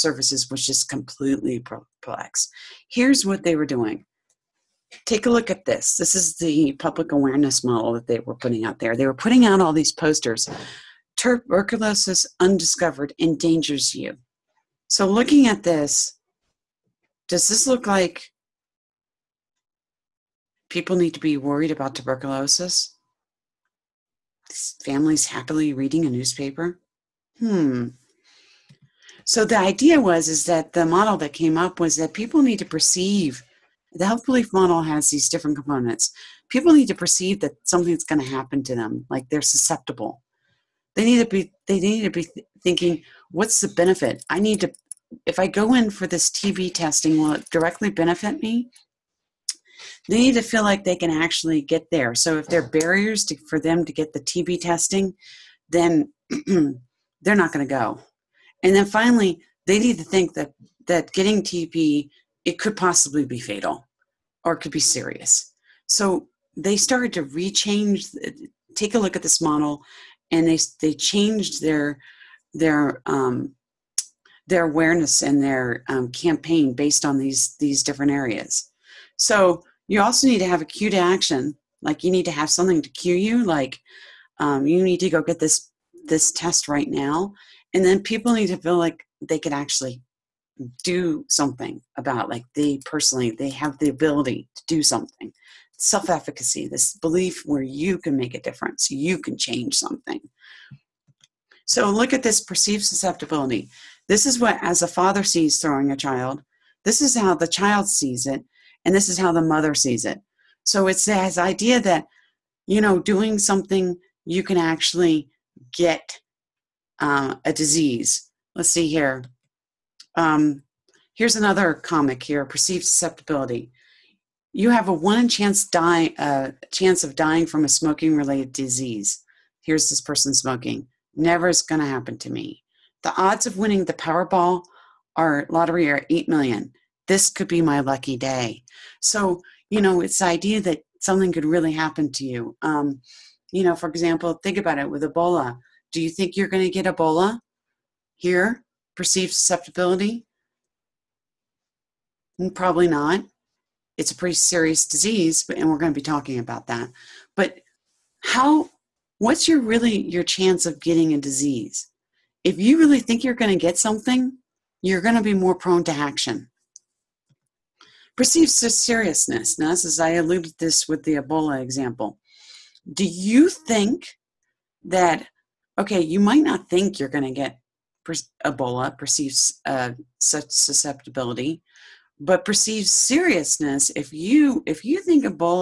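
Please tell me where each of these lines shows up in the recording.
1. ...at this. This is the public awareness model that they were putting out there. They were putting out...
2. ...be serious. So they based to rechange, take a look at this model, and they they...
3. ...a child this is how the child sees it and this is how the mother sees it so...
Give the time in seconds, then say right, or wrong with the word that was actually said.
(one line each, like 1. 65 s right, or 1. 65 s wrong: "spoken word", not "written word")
1. 5 s right
2. 64 s wrong: "started", not "based"
3. 105 s right.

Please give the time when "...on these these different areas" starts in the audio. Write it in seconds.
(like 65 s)
77 s.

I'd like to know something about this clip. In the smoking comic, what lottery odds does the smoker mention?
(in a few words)
8 million.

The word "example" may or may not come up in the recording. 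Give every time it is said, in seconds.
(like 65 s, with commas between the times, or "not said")
143 s, 171 s.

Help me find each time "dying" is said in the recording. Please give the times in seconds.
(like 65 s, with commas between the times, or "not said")
127 s.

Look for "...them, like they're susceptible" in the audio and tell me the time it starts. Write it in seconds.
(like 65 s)
38 s.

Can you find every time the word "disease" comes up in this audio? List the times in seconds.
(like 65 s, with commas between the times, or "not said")
117 s, 128 s, 154 s, 161 s.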